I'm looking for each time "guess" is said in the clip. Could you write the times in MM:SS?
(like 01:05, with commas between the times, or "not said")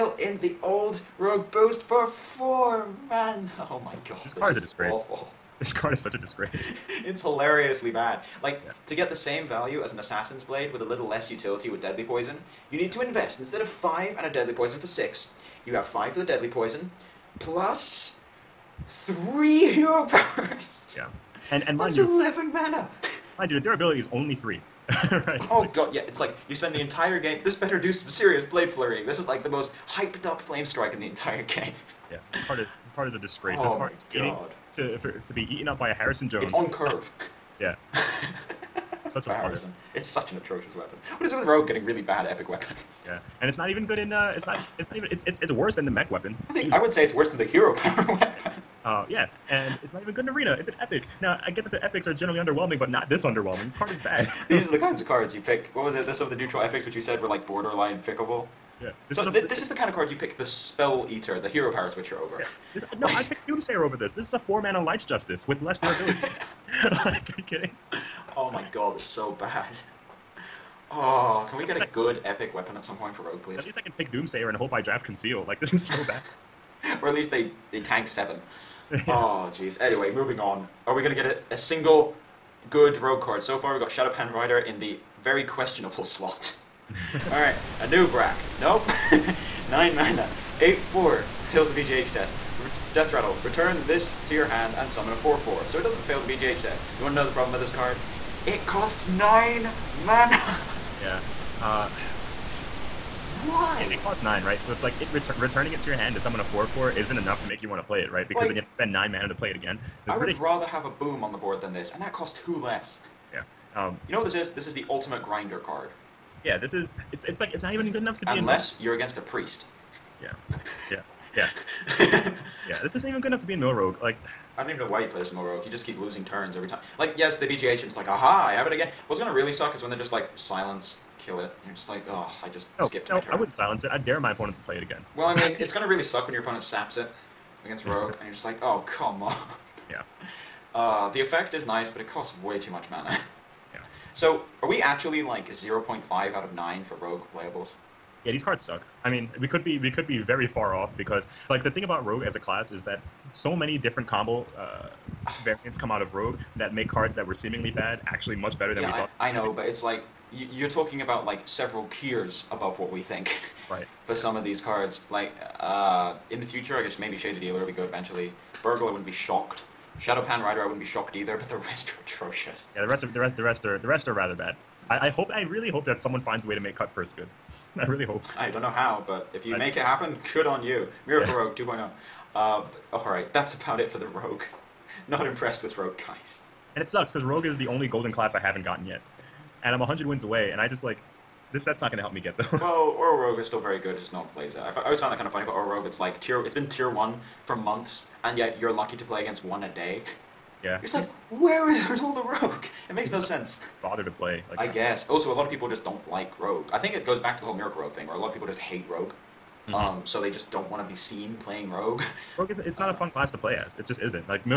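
02:46, 03:24.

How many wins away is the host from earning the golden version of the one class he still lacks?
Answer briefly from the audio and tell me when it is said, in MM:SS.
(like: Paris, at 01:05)
100, at 03:09.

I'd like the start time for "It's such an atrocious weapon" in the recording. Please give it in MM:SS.
00:39.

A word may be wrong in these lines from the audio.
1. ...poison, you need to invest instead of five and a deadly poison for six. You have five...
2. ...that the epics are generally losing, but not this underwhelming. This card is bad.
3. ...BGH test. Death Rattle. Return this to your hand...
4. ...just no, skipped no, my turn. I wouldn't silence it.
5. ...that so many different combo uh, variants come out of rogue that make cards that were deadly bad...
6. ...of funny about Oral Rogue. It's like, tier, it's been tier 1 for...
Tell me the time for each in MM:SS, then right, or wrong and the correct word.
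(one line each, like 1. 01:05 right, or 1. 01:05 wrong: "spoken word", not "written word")
1. 00:12 right
2. 00:51 wrong: "underwhelming", not "losing"
3. 01:31 right
4. 02:12 right
5. 02:32 wrong: "seemingly", not "deadly"
6. 03:15 right.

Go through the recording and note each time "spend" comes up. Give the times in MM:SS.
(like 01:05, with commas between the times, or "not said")
00:26, 01:48.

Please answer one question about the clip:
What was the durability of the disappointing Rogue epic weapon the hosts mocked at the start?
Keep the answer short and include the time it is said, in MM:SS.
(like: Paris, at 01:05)
3, at 00:23.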